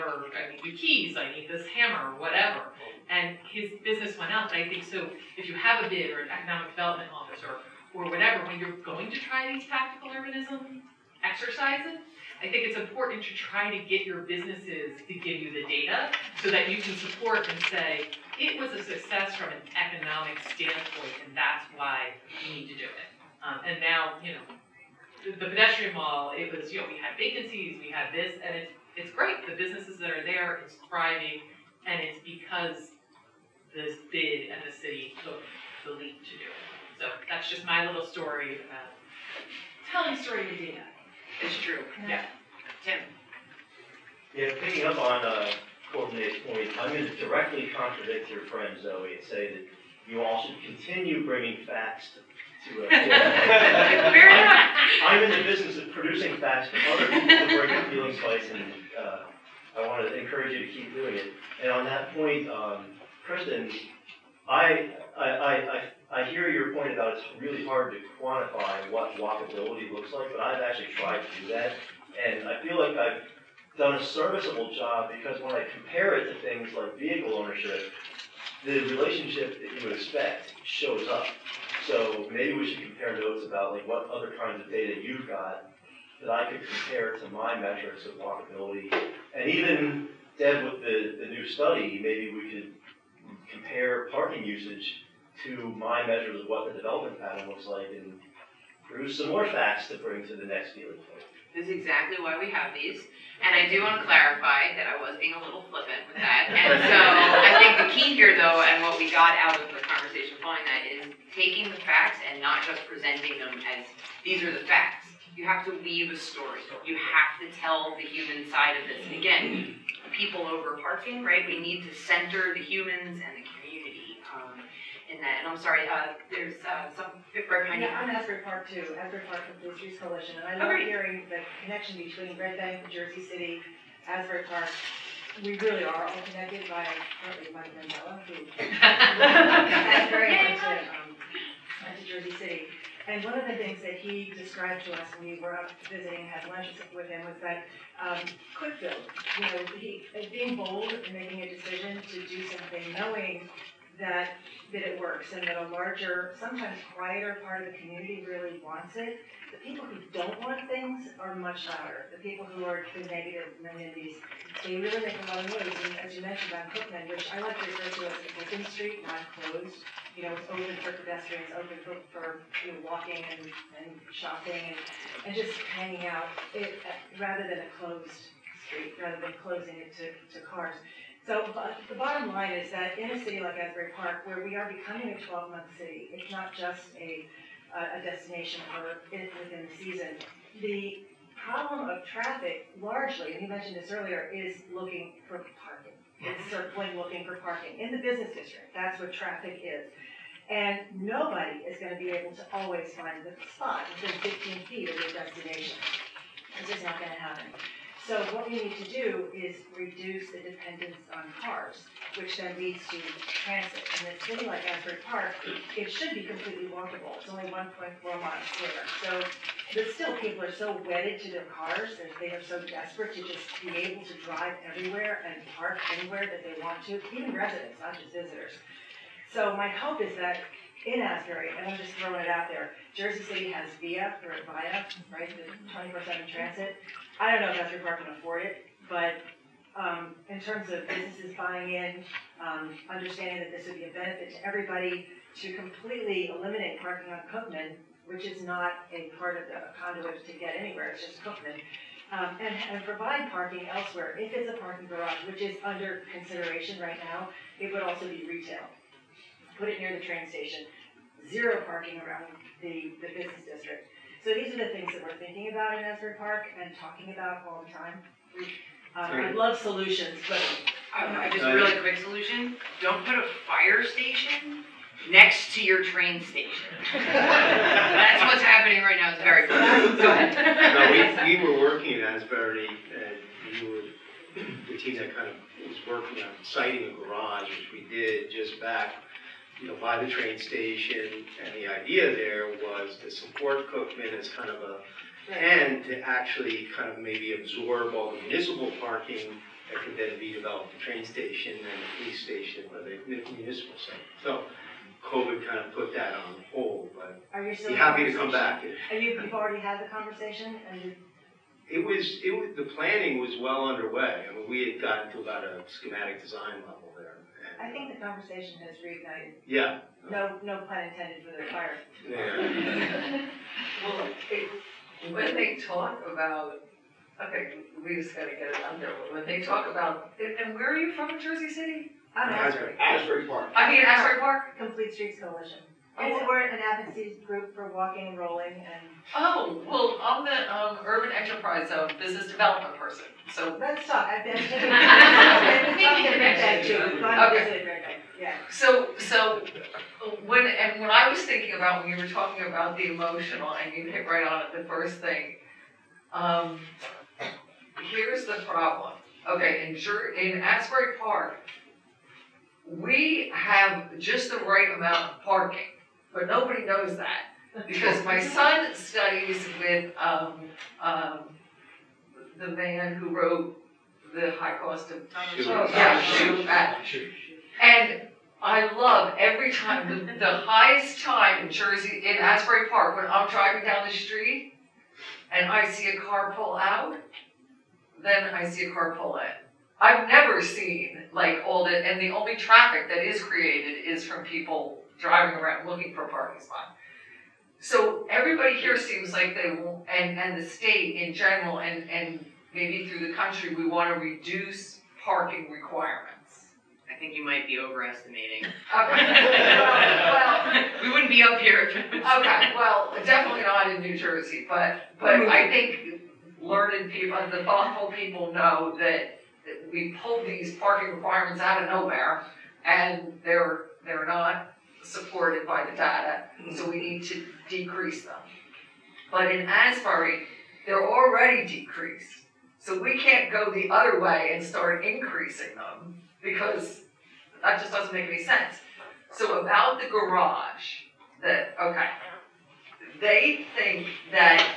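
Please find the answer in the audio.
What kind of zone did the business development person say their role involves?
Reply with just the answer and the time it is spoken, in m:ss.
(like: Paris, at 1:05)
urban enterprise zone, at 5:40.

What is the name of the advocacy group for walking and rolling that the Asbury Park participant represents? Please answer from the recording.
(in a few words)
Complete Streets Coalition.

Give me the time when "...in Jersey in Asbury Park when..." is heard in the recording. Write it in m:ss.
6:21.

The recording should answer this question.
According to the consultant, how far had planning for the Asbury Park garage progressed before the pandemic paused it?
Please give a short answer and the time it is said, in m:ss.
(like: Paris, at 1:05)
schematic design level, at 5:15.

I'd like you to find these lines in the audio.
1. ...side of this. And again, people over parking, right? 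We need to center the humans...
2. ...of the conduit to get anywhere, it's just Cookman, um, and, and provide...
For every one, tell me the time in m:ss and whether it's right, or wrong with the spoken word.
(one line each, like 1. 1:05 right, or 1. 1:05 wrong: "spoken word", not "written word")
1. 1:58 right
2. 4:09 right.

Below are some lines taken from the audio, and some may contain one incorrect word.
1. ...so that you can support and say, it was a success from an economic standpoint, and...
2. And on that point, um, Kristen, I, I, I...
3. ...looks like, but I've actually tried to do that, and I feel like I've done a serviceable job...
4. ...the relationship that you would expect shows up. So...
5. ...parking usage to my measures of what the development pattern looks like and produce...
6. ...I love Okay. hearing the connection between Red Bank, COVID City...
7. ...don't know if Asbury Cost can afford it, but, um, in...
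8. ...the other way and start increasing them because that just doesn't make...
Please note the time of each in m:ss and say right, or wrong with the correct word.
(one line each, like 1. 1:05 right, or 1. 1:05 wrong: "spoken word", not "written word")
1. 0:16 right
2. 1:01 right
3. 1:09 right
4. 1:18 right
5. 1:34 right
6. 2:10 wrong: "Jersey", not "COVID"
7. 3:57 wrong: "Park", not "Cost"
8. 7:13 right.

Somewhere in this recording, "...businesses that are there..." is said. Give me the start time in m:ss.
0:29.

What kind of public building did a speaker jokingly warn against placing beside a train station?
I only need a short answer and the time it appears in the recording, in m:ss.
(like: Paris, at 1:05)
fire station, at 4:33.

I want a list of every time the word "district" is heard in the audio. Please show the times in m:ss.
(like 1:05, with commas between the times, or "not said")
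3:18, 4:23.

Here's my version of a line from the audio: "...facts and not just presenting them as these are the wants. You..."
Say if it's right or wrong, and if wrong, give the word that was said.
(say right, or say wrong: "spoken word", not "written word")
wrong: "facts", not "wants".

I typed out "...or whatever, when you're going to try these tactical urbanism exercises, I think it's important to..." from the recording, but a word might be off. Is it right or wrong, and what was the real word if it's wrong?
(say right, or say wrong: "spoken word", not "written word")
right.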